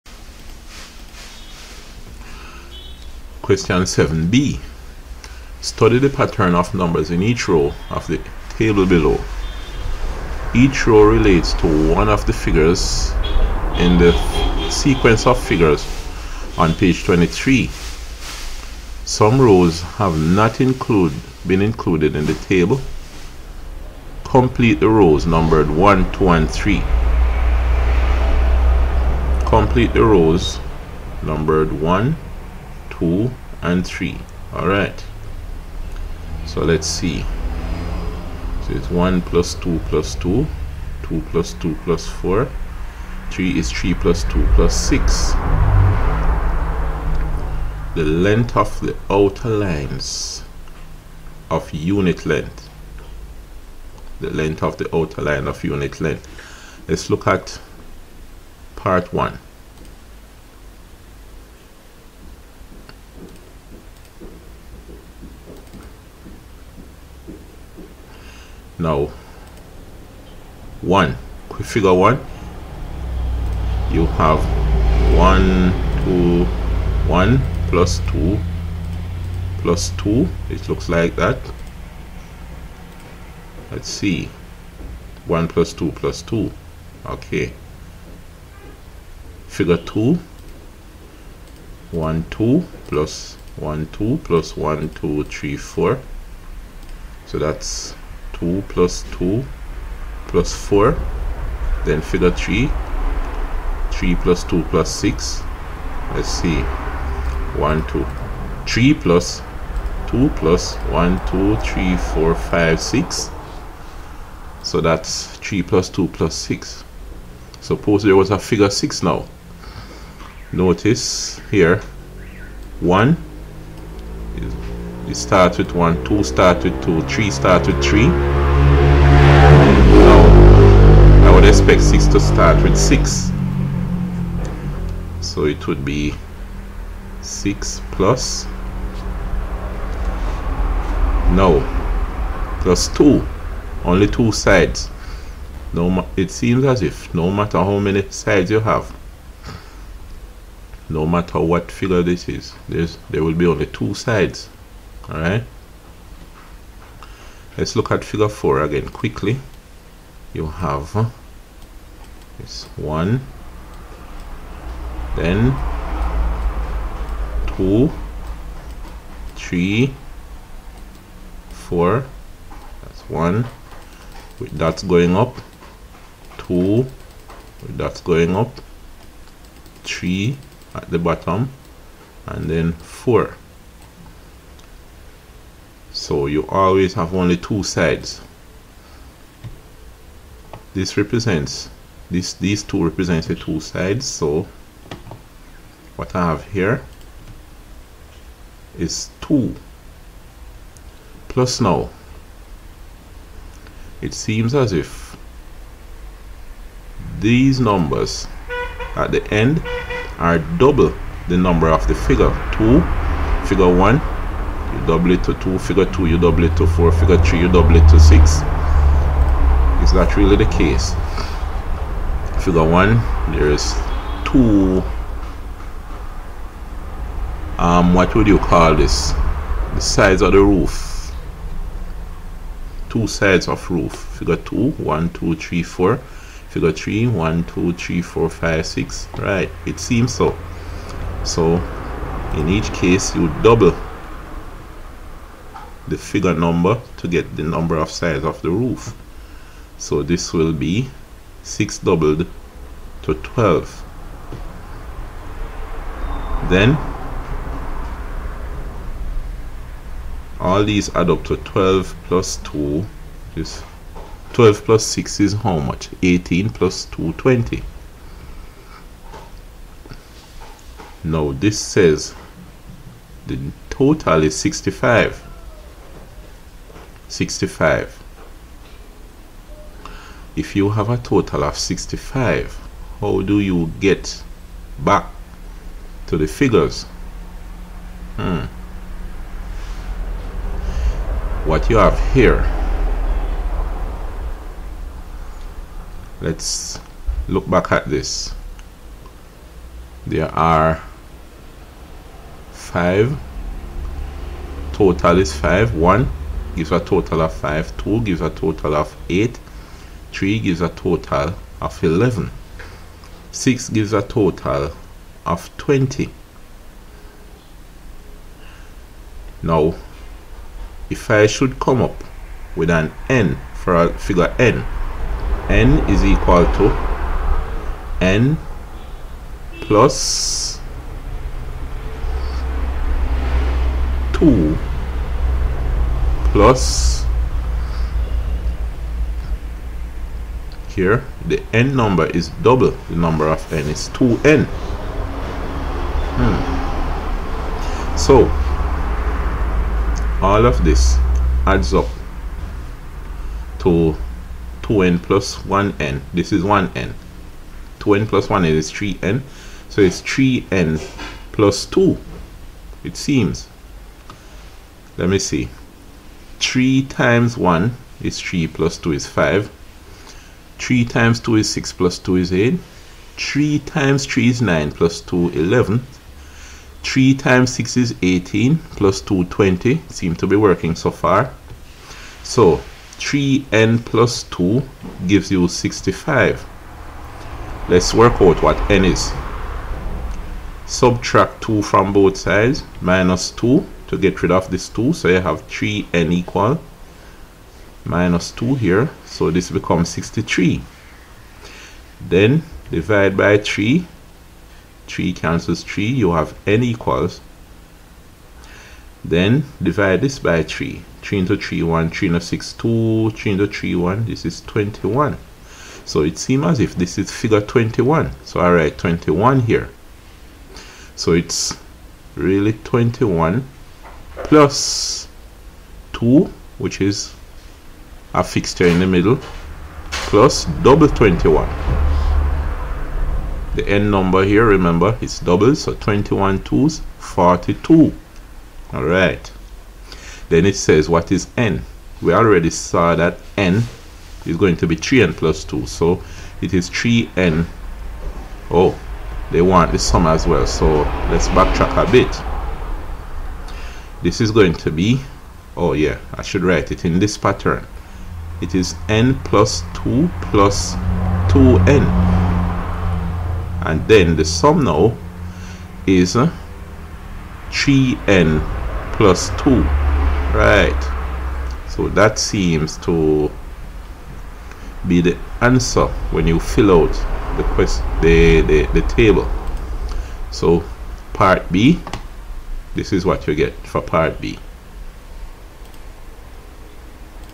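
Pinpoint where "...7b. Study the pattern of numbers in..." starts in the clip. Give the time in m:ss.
0:03.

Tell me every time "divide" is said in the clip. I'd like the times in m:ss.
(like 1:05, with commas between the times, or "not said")
6:42, 6:49.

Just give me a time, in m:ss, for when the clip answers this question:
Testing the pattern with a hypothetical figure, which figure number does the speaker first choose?
1:57.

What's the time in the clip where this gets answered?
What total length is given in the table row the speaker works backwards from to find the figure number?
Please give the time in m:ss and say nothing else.
4:31.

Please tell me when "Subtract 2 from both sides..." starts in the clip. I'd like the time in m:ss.
6:30.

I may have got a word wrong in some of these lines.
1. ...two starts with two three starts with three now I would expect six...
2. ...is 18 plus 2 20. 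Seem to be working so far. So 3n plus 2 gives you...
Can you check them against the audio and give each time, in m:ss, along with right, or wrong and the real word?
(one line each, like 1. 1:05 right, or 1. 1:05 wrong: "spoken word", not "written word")
1. 2:06 right
2. 6:17 right.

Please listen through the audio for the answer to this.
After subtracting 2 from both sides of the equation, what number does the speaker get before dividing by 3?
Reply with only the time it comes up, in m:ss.
6:39.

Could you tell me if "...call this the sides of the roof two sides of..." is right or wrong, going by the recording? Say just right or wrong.
right.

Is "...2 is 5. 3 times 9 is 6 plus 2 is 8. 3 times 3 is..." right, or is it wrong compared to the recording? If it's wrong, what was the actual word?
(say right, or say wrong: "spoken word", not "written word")
wrong: "2", not "9".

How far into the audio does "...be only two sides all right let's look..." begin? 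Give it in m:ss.
2:33.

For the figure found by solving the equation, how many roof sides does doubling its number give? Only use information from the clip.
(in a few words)
42.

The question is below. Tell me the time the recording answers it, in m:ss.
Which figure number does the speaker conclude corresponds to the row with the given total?
6:56.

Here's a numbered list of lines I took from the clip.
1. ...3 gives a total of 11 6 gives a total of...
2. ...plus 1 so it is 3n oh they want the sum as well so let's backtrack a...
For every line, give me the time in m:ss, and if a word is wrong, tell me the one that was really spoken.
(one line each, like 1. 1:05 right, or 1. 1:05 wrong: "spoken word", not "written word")
1. 5:10 right
2. 7:25 wrong: "2", not "1".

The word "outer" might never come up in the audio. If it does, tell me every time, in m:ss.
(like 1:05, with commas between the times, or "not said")
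0:49, 0:54.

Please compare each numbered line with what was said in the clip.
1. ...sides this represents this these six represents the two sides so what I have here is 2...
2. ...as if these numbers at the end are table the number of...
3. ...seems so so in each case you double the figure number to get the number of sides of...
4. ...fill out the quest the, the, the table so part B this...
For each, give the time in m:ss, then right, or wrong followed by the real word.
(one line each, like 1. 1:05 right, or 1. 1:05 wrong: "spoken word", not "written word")
1. 3:07 wrong: "two", not "six"
2. 3:24 wrong: "double", not "table"
3. 3:59 right
4. 7:56 right.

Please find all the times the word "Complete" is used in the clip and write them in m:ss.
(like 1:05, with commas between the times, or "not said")
0:24, 0:29.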